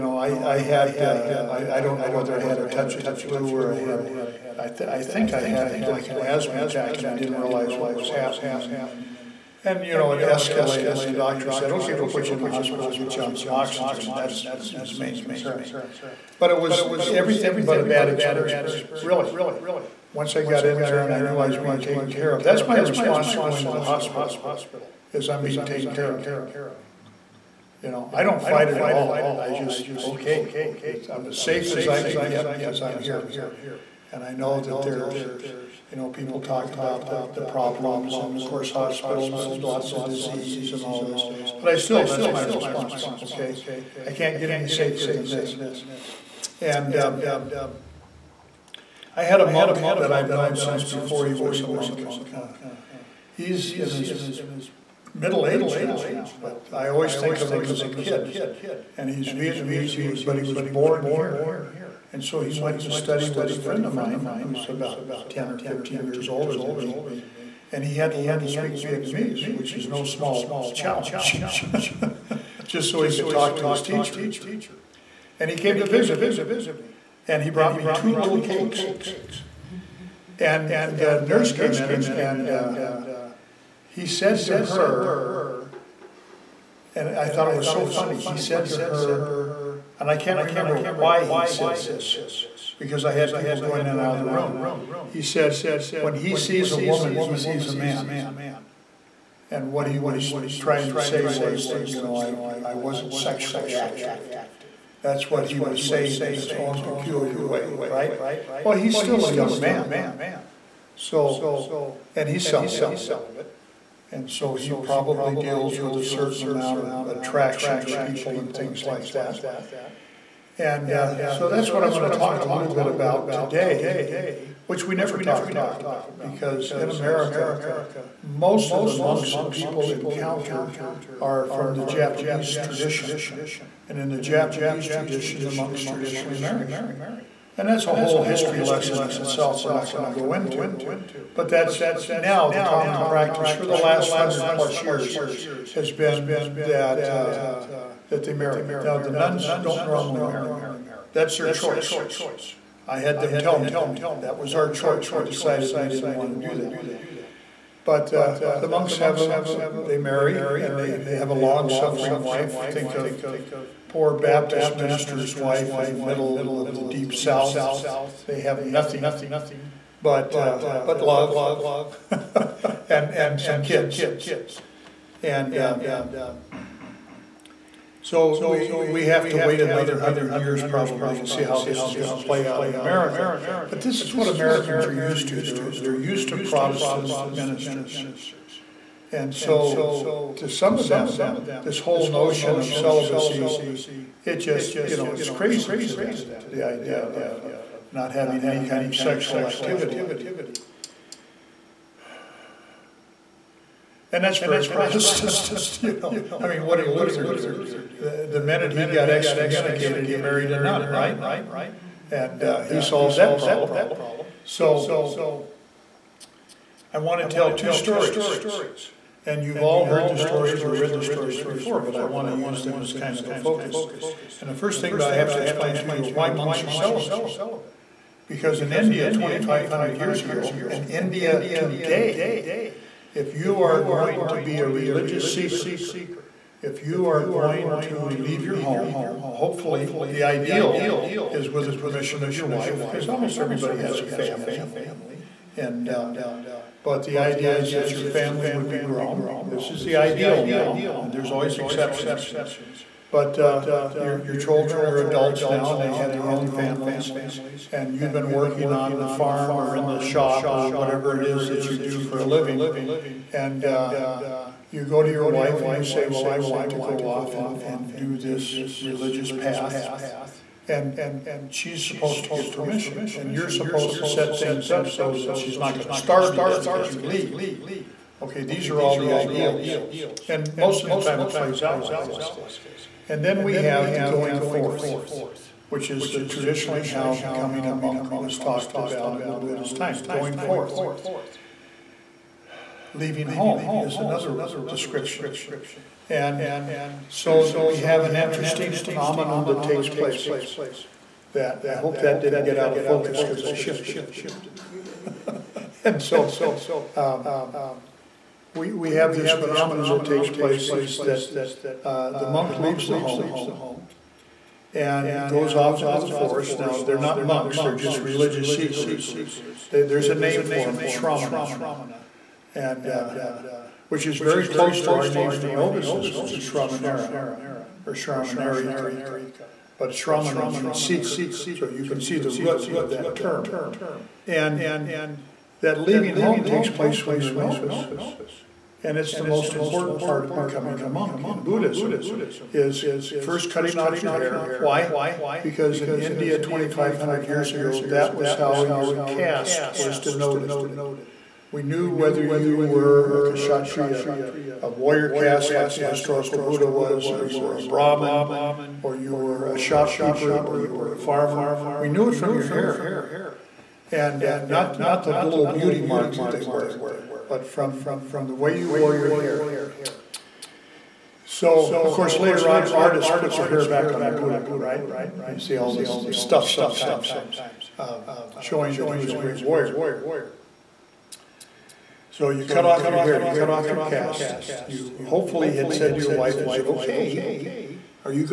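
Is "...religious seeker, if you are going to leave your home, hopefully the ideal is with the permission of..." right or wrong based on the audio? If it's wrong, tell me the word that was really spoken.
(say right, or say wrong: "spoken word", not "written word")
right.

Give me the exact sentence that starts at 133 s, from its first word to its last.
And in the Japanese tradition, the monks traditionally marry.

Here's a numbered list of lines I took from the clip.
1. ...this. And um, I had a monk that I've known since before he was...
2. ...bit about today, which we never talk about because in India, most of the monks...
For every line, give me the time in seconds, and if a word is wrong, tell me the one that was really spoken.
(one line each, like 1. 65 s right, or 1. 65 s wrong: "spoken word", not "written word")
1. 45 s right
2. 122 s wrong: "America", not "India".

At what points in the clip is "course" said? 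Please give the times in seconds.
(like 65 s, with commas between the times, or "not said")
38 s, 371 s.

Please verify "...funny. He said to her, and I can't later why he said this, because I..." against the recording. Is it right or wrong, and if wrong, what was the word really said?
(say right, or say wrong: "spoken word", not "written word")
wrong: "remember", not "later".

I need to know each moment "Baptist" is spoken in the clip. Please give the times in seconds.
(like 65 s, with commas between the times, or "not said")
164 s.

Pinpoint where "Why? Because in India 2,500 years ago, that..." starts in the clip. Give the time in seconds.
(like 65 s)
344 s.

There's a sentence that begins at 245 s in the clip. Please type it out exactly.
And uh, but the idea is that your family would be grown.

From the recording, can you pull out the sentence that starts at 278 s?
Okay, these are all the ideals.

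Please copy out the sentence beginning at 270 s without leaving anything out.
And she's supposed to give permission.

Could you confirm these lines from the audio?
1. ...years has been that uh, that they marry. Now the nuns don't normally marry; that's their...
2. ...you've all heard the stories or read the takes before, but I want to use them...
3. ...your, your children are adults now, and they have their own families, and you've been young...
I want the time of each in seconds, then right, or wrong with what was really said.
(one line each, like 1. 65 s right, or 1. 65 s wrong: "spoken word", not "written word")
1. 144 s right
2. 219 s wrong: "stories", not "takes"
3. 253 s wrong: "working", not "young".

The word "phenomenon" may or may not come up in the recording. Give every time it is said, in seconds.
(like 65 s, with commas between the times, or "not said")
298 s, 309 s.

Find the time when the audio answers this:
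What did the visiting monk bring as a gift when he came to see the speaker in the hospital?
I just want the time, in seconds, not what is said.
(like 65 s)
77 s.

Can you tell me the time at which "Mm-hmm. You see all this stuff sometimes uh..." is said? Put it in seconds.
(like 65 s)
374 s.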